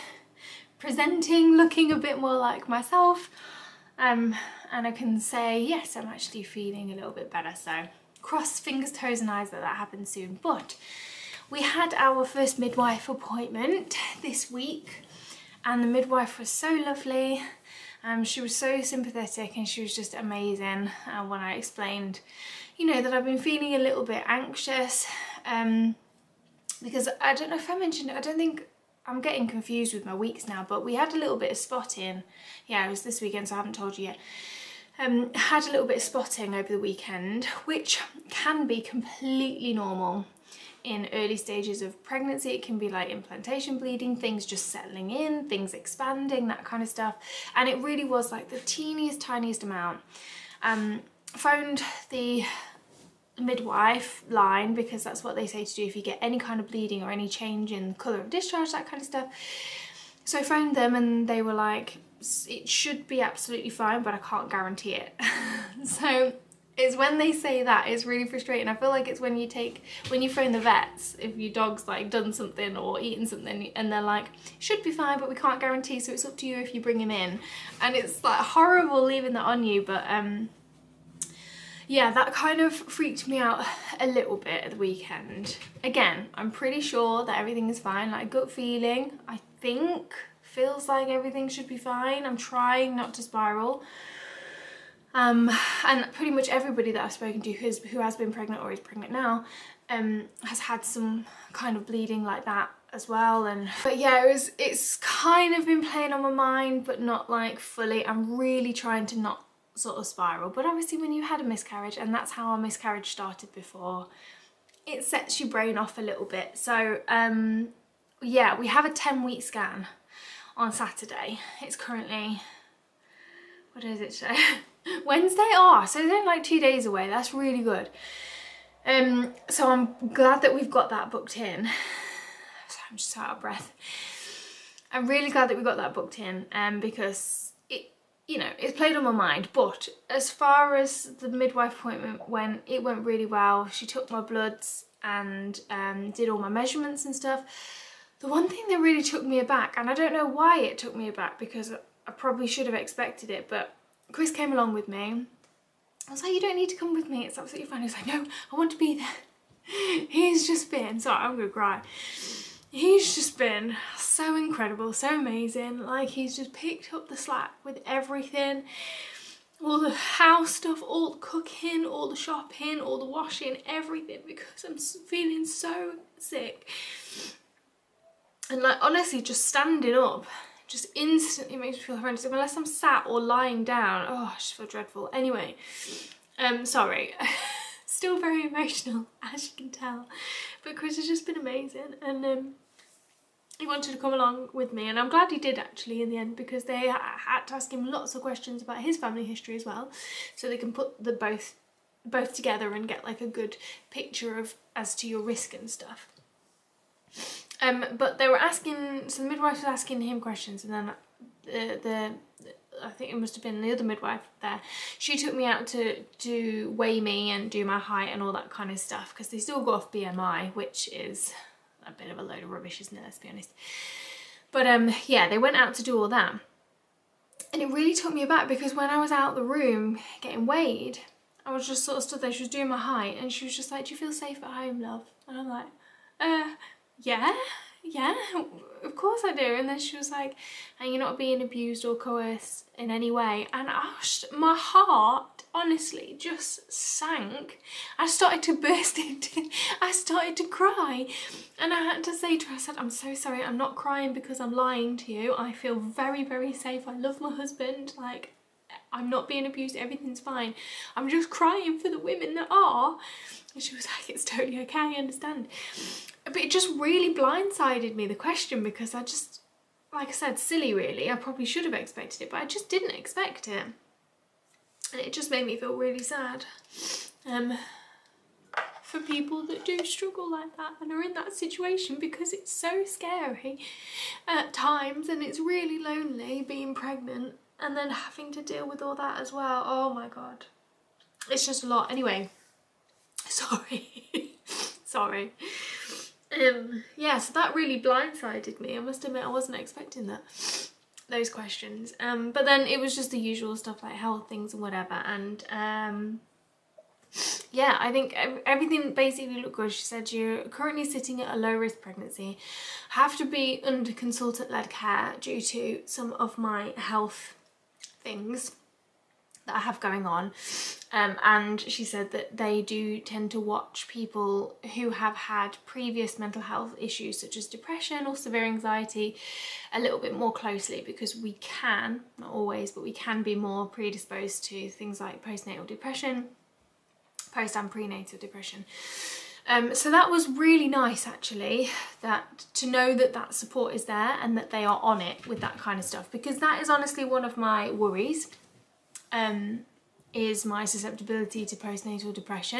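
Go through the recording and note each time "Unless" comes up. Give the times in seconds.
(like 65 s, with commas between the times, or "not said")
182 s.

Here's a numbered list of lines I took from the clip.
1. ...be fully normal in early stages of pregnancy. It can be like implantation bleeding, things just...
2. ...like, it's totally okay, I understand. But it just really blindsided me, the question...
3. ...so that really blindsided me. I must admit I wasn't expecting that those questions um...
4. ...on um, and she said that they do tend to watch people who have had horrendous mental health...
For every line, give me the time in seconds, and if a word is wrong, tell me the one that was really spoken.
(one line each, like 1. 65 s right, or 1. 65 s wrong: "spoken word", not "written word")
1. 38 s wrong: "completely", not "fully"
2. 263 s right
3. 297 s right
4. 320 s wrong: "previous", not "horrendous".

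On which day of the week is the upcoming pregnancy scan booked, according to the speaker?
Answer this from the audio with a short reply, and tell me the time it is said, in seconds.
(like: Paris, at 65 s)
Saturday, at 120 s.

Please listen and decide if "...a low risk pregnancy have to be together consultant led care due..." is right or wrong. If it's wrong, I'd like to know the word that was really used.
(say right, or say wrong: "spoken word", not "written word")
wrong: "under", not "together".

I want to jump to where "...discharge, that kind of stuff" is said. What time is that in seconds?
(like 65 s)
58 s.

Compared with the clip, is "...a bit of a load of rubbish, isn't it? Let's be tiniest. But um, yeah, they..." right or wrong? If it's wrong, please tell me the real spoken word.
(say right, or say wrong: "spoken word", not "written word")
wrong: "honest", not "tiniest".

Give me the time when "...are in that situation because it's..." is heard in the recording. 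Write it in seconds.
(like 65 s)
280 s.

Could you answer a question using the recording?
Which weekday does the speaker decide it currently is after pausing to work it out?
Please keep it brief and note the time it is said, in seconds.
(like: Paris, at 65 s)
Wednesday, at 125 s.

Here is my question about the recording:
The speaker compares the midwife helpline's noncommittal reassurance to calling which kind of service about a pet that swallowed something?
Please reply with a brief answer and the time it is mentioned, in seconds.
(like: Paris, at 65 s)
the vets, at 70 s.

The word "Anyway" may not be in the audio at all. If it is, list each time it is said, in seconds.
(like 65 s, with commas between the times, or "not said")
185 s, 291 s.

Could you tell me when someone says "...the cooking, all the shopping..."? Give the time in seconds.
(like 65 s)
171 s.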